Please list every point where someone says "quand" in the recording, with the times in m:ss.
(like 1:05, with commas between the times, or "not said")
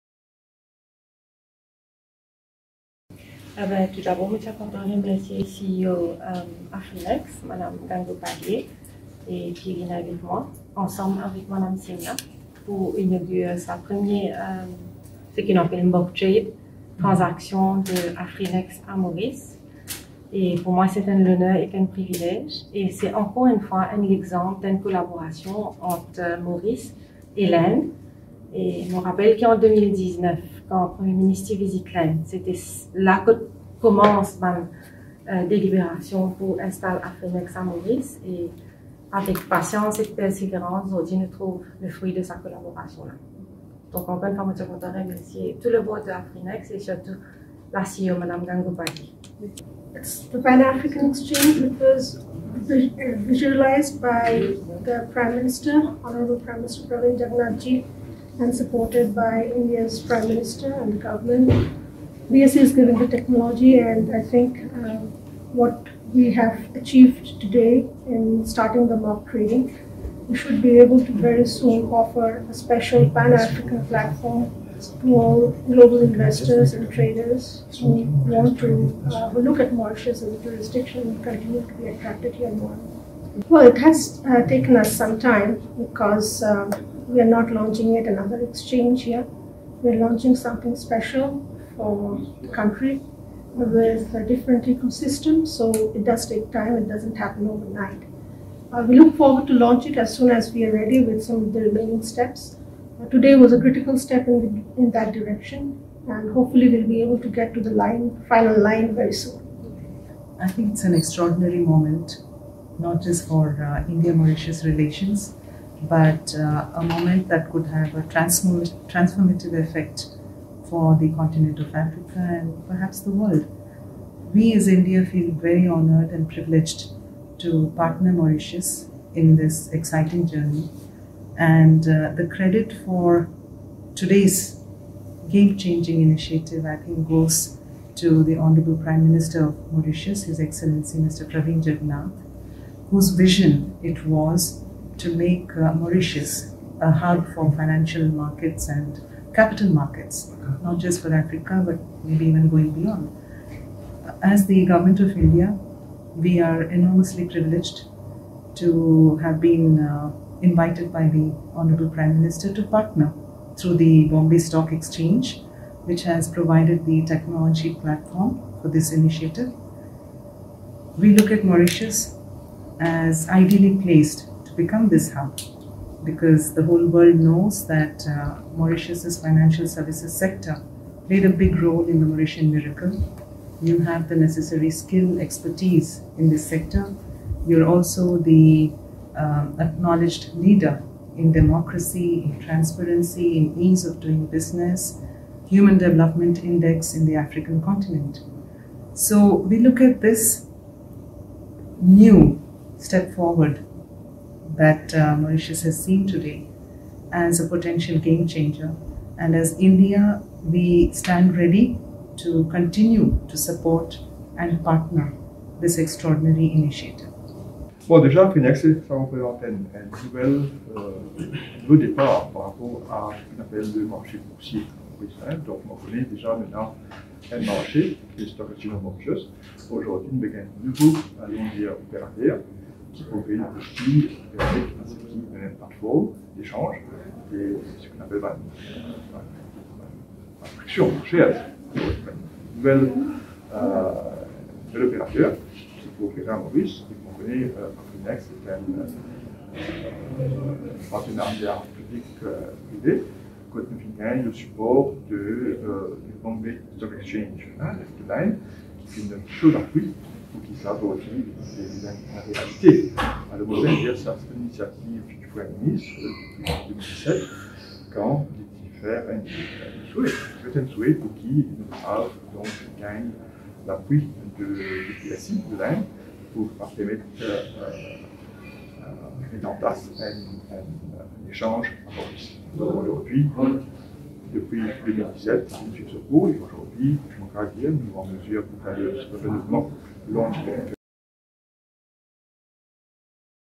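0:30, 4:13, 4:27.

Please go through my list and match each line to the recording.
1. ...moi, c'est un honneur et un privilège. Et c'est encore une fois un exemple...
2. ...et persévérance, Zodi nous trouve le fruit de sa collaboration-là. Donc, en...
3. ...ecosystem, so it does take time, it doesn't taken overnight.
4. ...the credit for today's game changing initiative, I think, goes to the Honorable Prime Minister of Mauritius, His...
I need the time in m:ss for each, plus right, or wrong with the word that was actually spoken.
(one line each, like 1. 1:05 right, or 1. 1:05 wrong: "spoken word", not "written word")
1. 0:20 right
2. 0:39 right
3. 1:34 wrong: "happen", not "taken"
4. 2:12 right.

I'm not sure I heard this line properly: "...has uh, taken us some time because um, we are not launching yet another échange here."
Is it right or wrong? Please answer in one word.
wrong.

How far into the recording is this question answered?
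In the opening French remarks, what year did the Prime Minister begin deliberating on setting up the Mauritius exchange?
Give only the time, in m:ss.
0:29.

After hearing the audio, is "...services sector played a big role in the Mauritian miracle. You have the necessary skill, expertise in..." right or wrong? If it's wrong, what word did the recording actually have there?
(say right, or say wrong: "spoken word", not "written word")
right.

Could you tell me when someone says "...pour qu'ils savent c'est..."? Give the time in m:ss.
4:20.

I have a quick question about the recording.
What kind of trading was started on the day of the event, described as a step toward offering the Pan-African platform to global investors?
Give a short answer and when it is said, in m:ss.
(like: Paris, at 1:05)
mock trading, at 1:08.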